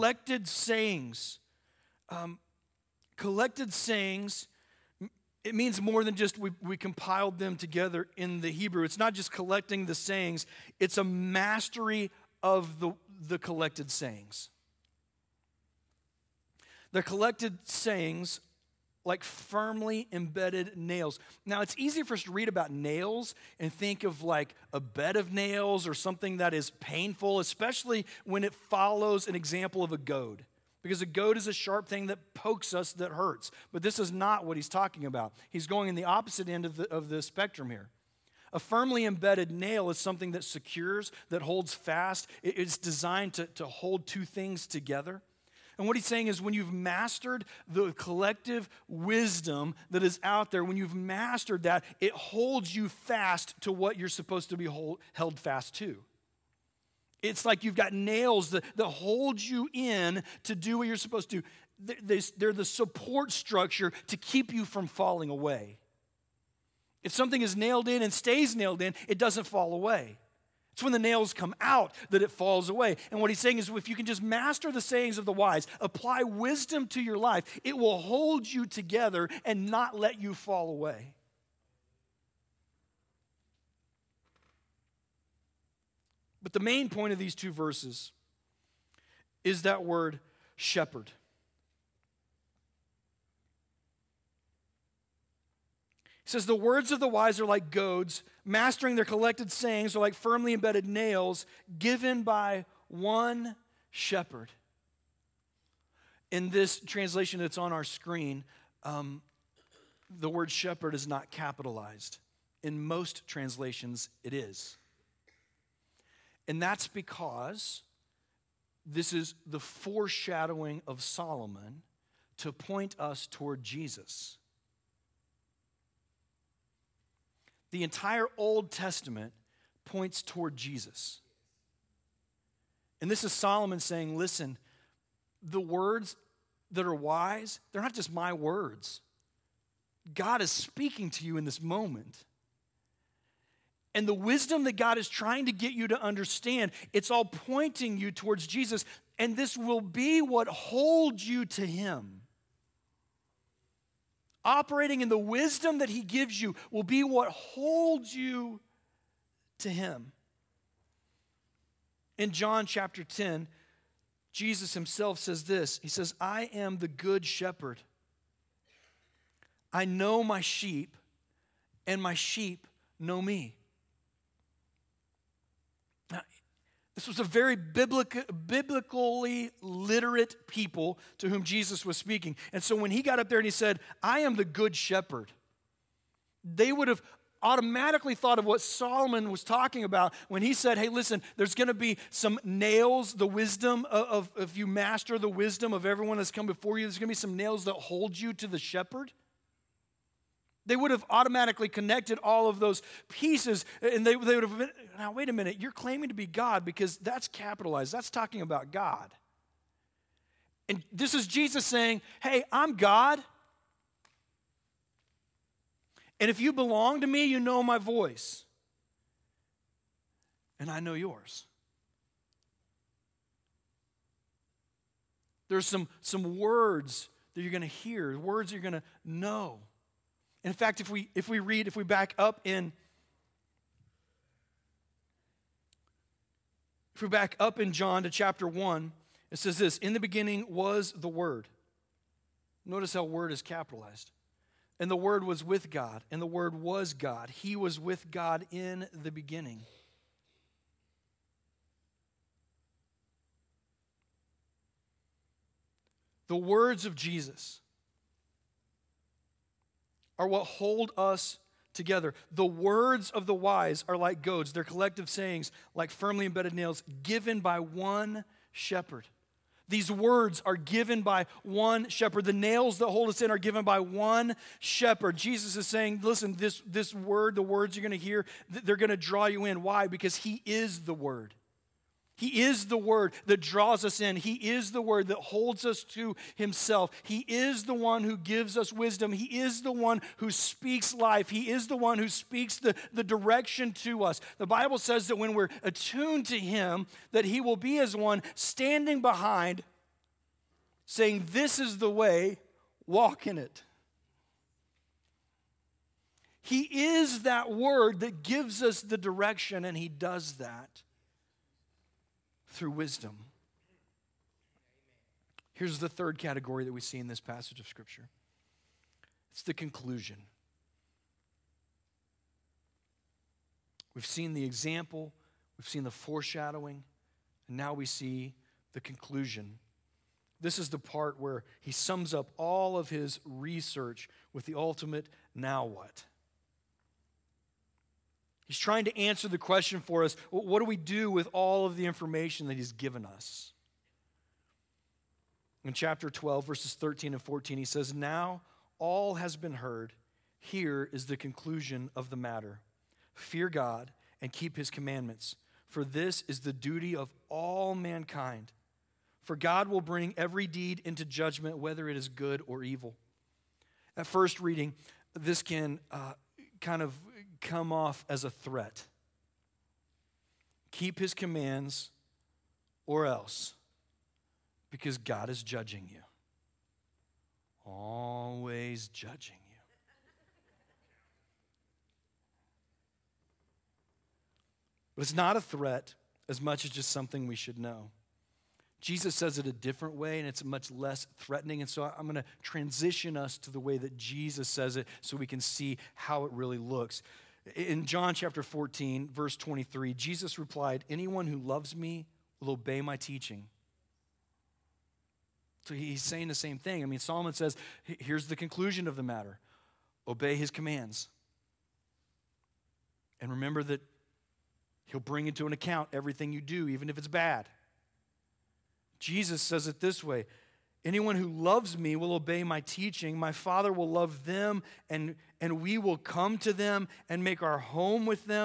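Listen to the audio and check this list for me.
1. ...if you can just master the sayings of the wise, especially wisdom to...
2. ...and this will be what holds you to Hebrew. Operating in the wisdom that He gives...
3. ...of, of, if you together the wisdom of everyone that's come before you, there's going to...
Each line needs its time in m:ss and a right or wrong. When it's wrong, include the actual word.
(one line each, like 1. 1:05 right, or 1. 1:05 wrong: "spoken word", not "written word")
1. 1:13 wrong: "apply", not "especially"
2. 2:29 wrong: "Him", not "Hebrew"
3. 3:13 wrong: "master", not "together".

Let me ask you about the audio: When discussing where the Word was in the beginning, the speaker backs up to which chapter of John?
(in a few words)
Chapter 1.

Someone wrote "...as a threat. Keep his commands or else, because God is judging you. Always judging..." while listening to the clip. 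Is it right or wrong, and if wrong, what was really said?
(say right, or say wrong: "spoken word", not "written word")
right.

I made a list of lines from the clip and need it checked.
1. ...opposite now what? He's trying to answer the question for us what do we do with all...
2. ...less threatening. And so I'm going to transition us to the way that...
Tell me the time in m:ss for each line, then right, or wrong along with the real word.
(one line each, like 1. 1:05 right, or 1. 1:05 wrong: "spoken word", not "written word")
1. 5:34 wrong: "ultimate", not "opposite"
2. 6:30 right.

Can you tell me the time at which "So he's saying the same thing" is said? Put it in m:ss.
6:45.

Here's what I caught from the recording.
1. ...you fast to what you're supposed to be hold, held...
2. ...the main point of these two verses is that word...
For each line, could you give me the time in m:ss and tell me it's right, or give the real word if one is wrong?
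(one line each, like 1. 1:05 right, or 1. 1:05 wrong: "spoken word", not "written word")
1. 0:52 right
2. 1:26 right.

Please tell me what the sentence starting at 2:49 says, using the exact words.
I know my sheep, and my sheep know me.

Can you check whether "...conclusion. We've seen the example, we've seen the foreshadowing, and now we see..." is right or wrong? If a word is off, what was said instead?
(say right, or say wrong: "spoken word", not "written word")
right.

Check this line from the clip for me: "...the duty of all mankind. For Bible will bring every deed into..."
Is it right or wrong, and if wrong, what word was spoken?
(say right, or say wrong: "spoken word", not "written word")
wrong: "God", not "Bible".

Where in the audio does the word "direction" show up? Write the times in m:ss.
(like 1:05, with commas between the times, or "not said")
4:53, 5:08.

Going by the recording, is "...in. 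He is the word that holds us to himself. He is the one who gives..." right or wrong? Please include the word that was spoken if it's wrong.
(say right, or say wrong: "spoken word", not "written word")
right.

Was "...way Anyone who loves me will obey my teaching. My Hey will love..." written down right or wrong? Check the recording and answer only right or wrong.
wrong.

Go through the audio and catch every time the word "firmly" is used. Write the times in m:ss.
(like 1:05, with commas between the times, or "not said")
0:19, 0:38, 1:40, 4:25.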